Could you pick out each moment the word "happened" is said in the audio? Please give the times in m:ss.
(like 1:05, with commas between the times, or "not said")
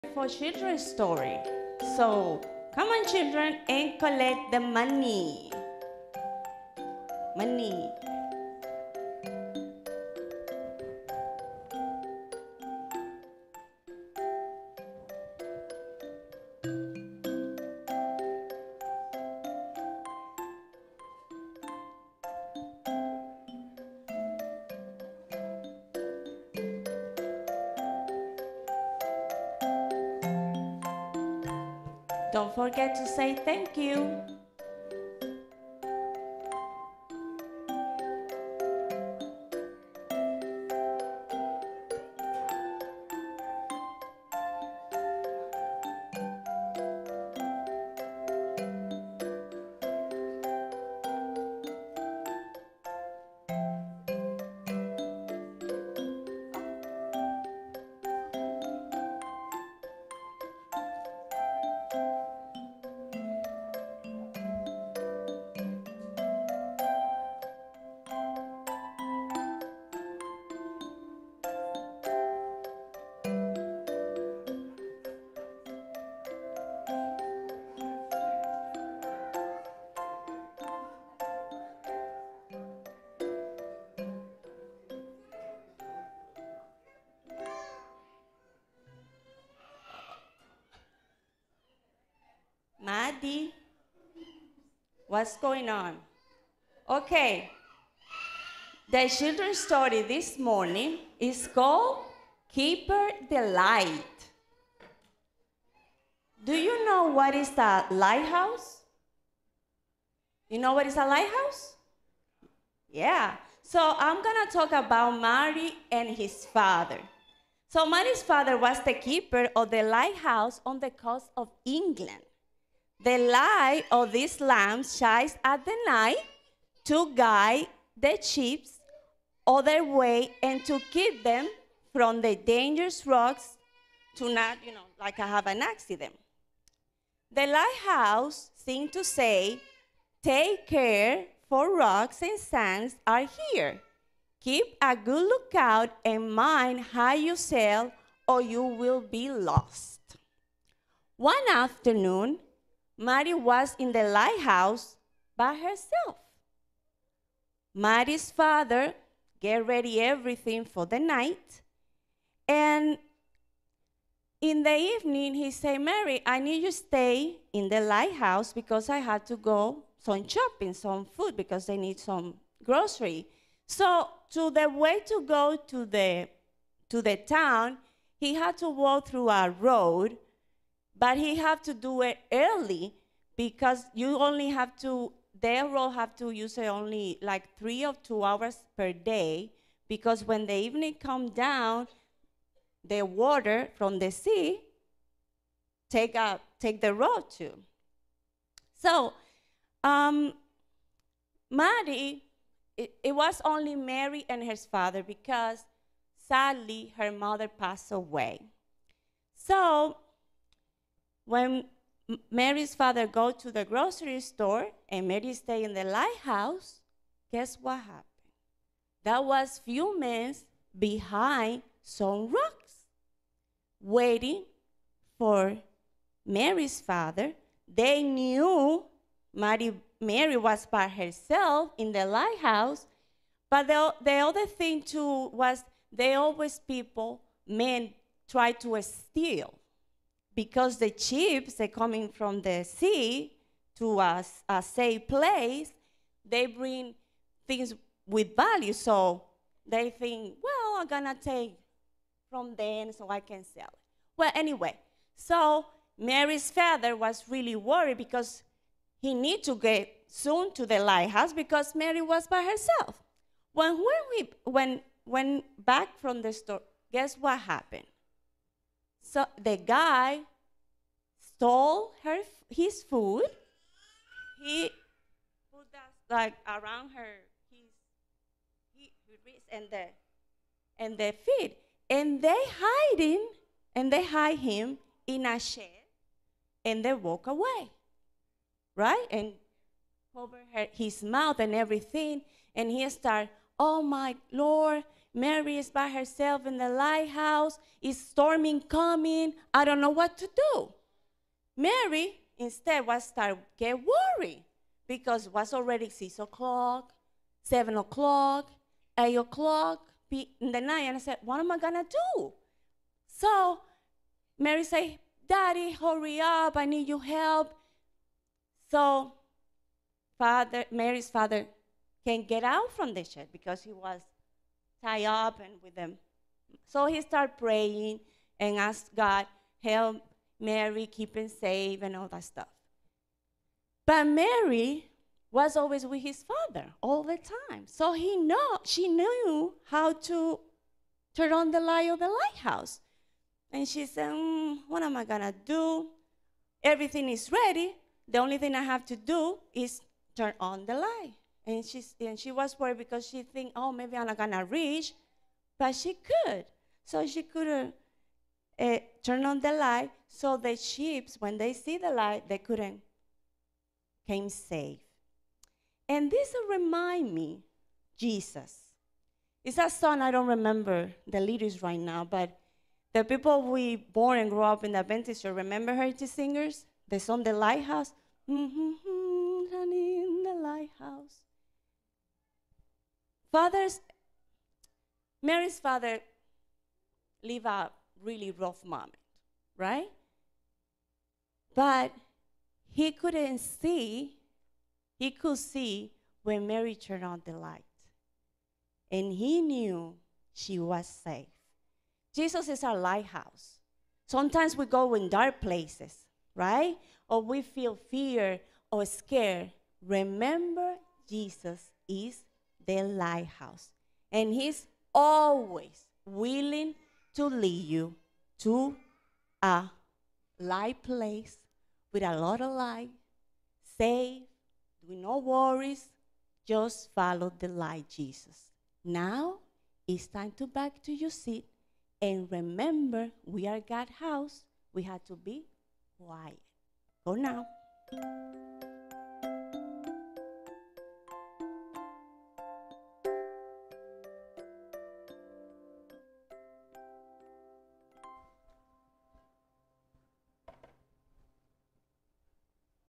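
3:37, 4:27.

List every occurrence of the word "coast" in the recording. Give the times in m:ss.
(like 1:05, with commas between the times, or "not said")
2:00.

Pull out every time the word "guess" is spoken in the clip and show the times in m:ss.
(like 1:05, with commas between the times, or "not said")
3:37, 4:26.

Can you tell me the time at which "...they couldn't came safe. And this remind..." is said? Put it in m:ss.
6:02.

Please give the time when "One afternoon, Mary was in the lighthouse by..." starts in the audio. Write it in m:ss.
2:31.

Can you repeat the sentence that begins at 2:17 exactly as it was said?
The lighthouse seemed to say, Take care, for rocks and sands are here.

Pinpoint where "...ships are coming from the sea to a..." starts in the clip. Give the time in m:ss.
4:00.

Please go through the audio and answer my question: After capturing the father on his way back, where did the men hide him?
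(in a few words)
in a shed.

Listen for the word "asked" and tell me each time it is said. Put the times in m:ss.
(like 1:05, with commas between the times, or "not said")
5:28.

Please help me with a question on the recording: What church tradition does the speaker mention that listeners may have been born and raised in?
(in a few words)
Adventist church.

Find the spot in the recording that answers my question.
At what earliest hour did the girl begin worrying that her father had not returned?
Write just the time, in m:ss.
5:05.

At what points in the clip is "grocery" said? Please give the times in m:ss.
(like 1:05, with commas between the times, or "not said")
2:52, 3:33.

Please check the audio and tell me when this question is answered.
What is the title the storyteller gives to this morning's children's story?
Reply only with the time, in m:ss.
1:42.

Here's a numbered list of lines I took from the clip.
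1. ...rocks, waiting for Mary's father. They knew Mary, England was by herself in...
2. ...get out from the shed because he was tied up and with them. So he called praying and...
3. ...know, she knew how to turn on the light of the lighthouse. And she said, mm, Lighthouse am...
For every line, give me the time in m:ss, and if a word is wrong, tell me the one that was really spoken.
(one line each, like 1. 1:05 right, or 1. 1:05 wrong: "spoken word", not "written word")
1. 3:42 wrong: "Mary", not "England"
2. 5:22 wrong: "started", not "called"
3. 5:38 wrong: "What", not "Lighthouse".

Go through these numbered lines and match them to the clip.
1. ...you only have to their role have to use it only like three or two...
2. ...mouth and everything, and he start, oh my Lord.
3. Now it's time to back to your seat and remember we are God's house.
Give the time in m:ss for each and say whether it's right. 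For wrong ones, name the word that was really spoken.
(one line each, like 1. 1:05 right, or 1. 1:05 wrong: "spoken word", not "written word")
1. 3:03 right
2. 4:51 right
3. 7:08 right.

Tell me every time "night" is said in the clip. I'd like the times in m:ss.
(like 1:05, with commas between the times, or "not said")
2:05, 2:40, 5:10.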